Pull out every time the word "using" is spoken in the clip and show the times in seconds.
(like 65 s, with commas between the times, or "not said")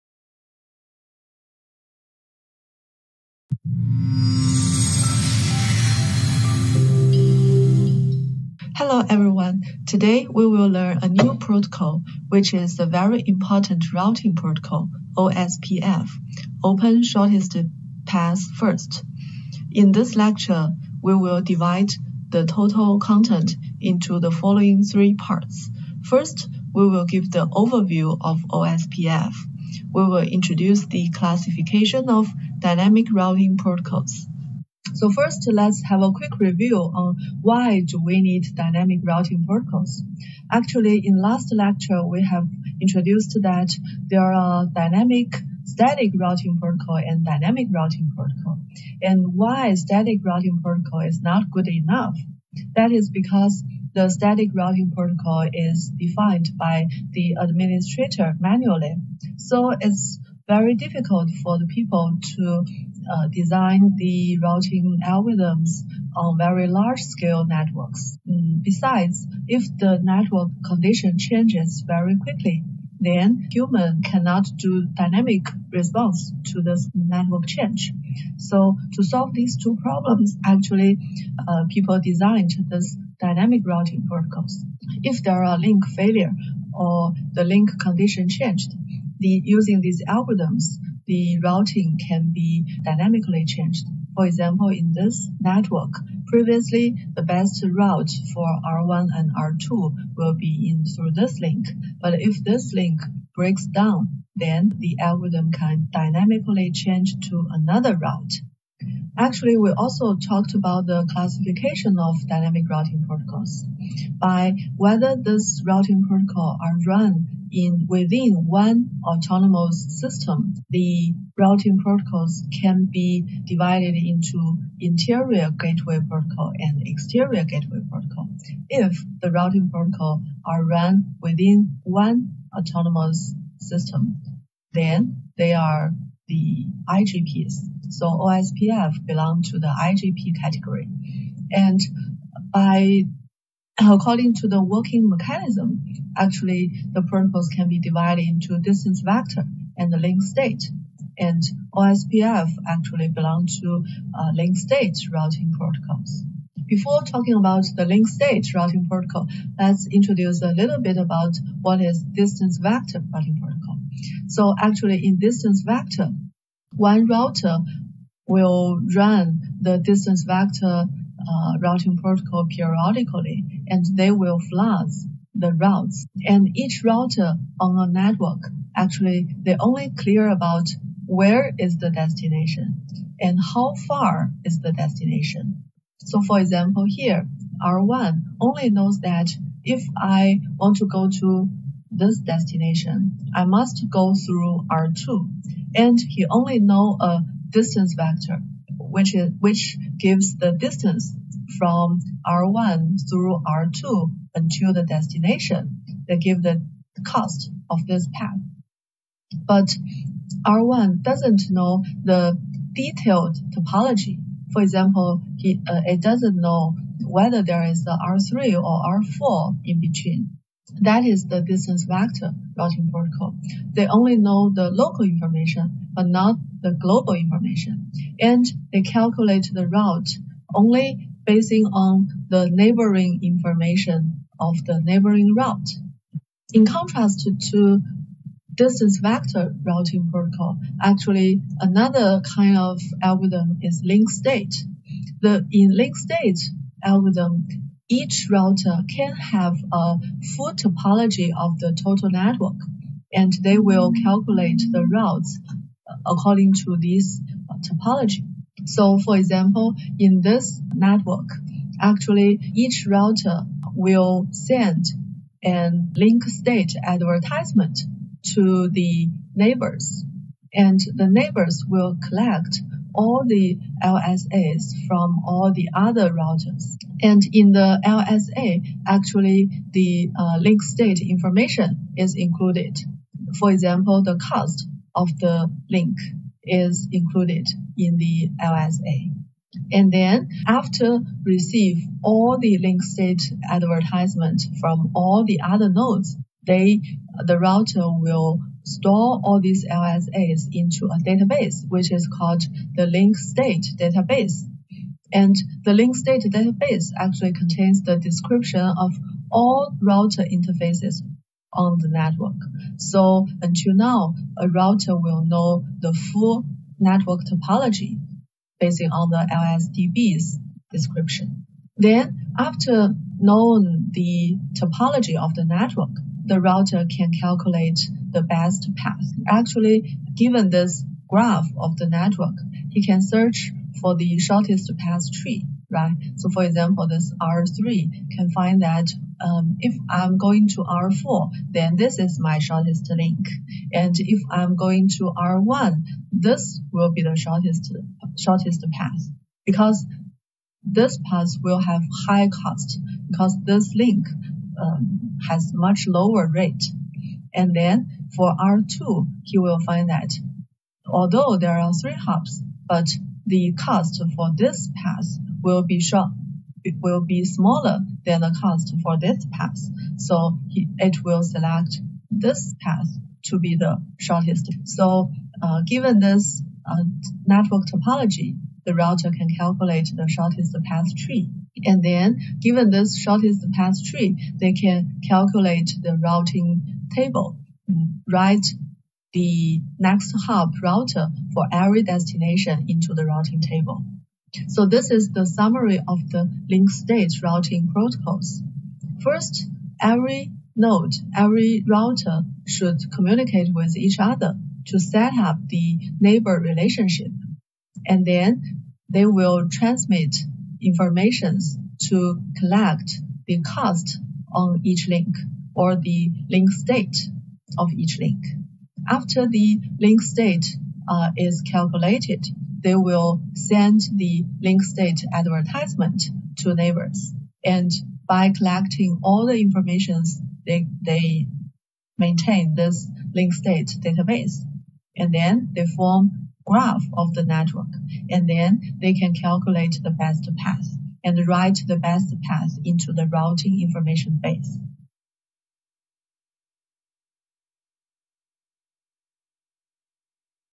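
89 s.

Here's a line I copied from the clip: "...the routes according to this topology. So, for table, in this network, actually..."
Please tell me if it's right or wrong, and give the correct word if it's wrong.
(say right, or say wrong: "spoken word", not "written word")
wrong: "example", not "table".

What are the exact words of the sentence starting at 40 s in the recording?
Actually, in last lecture, we have introduced that there are dynamic static routing protocol and dynamic routing protocol.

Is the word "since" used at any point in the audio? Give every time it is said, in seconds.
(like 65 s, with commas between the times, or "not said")
not said.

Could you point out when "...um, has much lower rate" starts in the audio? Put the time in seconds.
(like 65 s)
354 s.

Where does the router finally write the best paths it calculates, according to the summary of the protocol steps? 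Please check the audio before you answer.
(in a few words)
routing information base.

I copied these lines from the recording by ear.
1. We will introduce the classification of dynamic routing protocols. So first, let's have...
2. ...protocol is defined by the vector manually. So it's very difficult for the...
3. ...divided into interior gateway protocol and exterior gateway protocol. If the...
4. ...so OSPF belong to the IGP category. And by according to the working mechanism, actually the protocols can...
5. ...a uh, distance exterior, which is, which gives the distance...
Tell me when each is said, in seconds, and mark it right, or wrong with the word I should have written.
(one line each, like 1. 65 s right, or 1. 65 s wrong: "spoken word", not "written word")
1. 29 s right
2. 54 s wrong: "administrator", not "vector"
3. 123 s right
4. 137 s right
5. 196 s wrong: "vector", not "exterior".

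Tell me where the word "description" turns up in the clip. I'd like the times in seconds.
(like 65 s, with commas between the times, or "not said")
307 s, 320 s.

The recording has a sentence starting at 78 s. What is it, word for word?
So to solve these two problems, actually, uh, people designed this dynamic routing protocols.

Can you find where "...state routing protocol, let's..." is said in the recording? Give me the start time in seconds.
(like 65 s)
158 s.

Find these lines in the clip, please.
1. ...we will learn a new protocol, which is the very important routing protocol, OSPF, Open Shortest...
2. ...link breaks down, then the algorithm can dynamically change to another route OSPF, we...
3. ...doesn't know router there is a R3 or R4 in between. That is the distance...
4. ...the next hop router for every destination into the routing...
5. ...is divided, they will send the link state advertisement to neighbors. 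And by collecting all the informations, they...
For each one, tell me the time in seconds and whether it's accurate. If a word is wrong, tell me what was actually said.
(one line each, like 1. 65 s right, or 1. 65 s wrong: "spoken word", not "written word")
1. 10 s right
2. 102 s wrong: "Actually", not "OSPF"
3. 216 s wrong: "whether", not "router"
4. 389 s right
5. 421 s wrong: "calculated", not "divided".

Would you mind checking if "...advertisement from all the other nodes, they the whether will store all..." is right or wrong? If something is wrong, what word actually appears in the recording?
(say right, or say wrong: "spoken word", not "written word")
wrong: "router", not "whether".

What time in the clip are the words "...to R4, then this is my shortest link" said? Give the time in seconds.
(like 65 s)
340 s.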